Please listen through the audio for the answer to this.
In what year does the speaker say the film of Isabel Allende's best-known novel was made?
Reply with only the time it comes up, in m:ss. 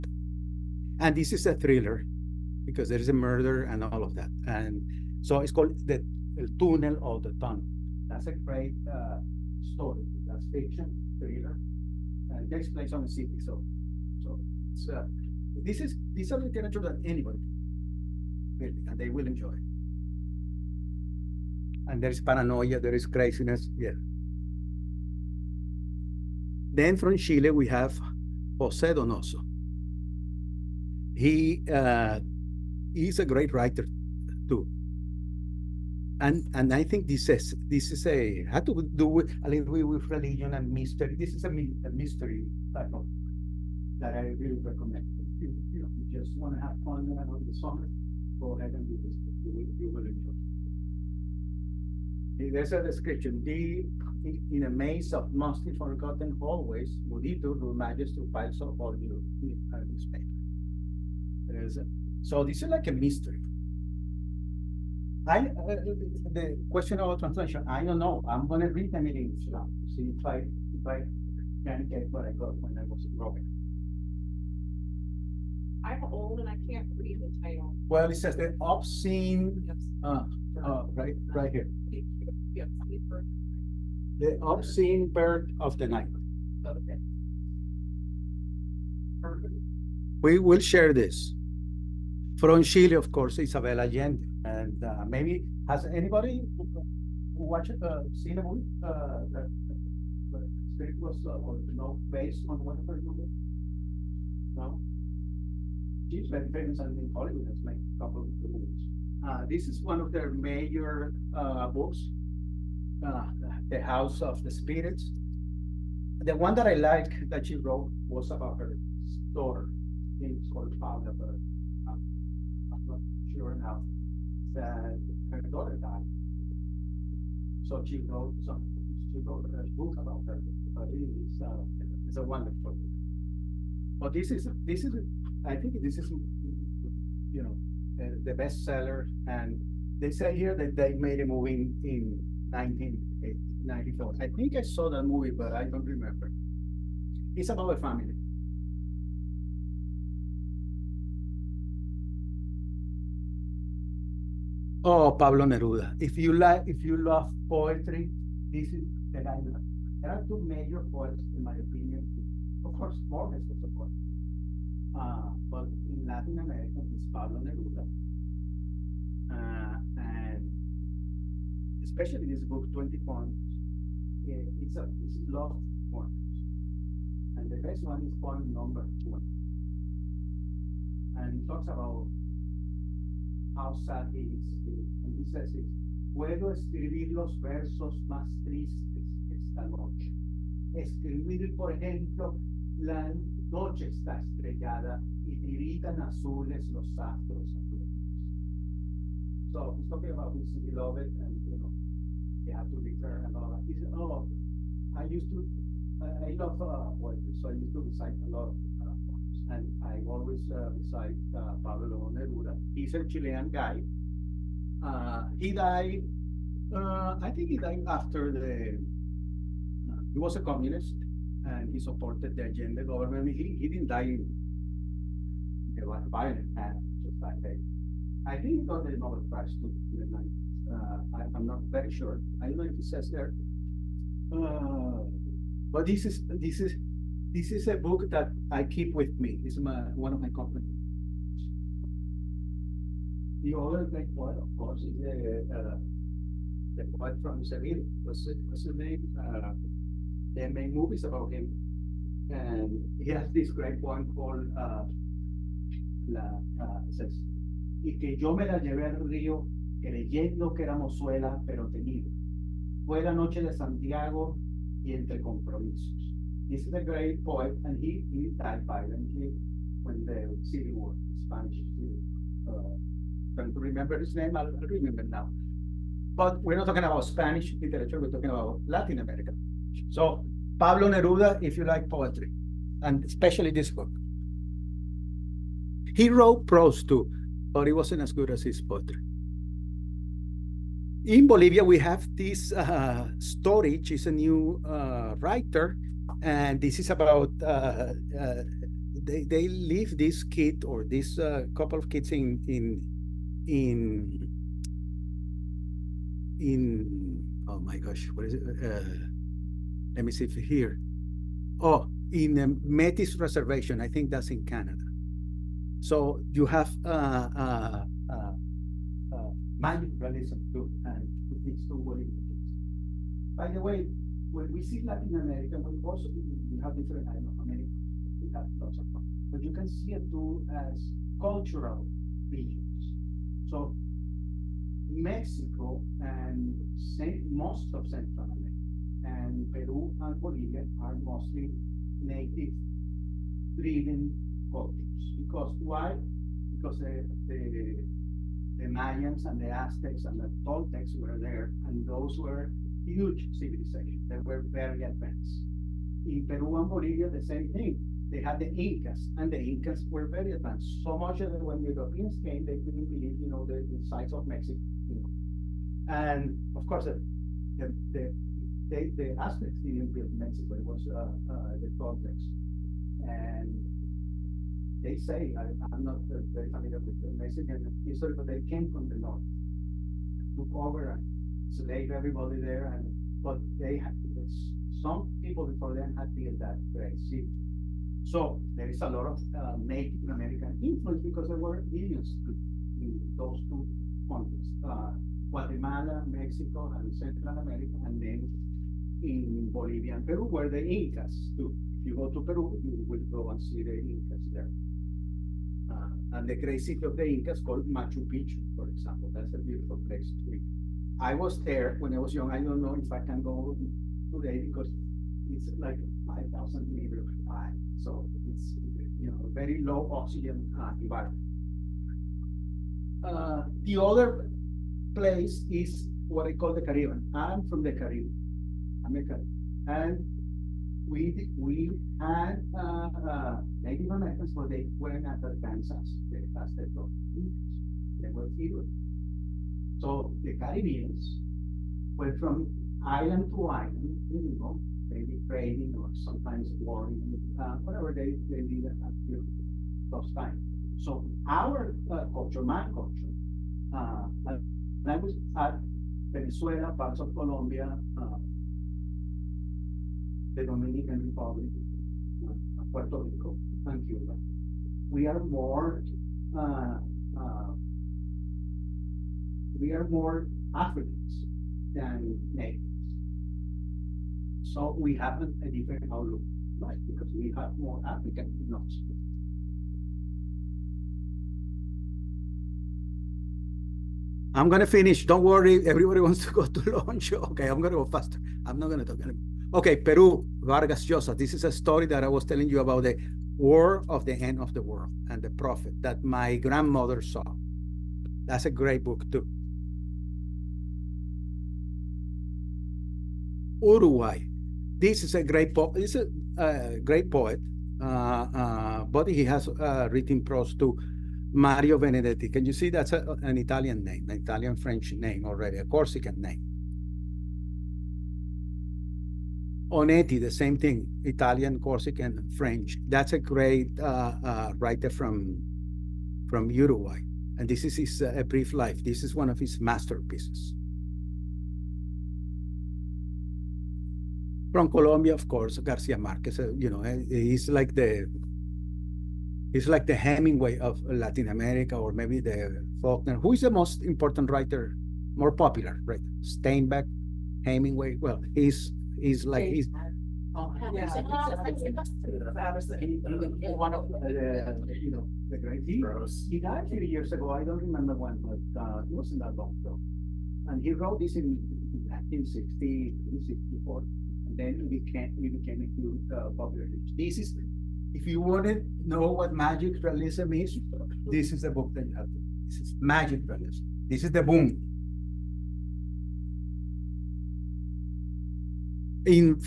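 2:22.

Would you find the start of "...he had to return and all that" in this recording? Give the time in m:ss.
3:22.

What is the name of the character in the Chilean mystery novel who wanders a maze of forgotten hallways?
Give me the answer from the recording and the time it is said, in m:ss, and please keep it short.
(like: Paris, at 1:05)
Mudito, at 0:57.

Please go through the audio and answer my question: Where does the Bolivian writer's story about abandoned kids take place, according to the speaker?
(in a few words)
Metis Reservation.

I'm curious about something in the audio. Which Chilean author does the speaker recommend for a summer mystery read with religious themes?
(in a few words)
Jose Donoso.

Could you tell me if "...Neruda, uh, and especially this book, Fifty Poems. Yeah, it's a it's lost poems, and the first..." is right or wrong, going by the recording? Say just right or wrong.
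wrong.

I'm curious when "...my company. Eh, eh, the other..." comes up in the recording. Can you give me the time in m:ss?
4:00.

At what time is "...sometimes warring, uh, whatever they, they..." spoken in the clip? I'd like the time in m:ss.
7:25.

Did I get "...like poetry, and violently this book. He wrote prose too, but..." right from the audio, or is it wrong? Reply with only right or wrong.
wrong.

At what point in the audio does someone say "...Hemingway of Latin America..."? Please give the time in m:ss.
8:59.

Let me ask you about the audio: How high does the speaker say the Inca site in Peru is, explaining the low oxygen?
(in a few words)
5,000 meters.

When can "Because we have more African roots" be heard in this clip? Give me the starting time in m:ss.
7:56.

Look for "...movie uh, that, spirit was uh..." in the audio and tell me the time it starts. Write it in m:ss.
1:38.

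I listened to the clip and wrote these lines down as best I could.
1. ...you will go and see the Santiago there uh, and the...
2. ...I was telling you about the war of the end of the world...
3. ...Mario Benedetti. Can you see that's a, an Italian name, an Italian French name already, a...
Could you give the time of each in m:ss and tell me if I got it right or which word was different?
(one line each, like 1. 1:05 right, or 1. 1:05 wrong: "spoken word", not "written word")
1. 6:42 wrong: "Incas", not "Santiago"
2. 8:12 right
3. 8:31 right.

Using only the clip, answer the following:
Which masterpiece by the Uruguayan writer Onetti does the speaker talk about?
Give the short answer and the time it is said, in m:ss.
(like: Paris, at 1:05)
A Brief Life, at 8:48.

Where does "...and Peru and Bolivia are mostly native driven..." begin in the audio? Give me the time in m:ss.
5:39.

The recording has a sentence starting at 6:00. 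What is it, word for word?
So much that when the Europeans came, they couldn't believe, you know, the, the size of Mexico.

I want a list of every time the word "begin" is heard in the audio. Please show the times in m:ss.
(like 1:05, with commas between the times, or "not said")
not said.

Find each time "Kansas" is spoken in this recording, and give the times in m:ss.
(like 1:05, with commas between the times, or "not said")
7:15.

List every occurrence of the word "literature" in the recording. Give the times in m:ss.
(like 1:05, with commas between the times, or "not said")
0:16, 4:37.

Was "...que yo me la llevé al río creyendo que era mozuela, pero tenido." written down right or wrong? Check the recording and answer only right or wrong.
right.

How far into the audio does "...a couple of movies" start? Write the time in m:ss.
1:47.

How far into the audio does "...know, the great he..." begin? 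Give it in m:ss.
9:14.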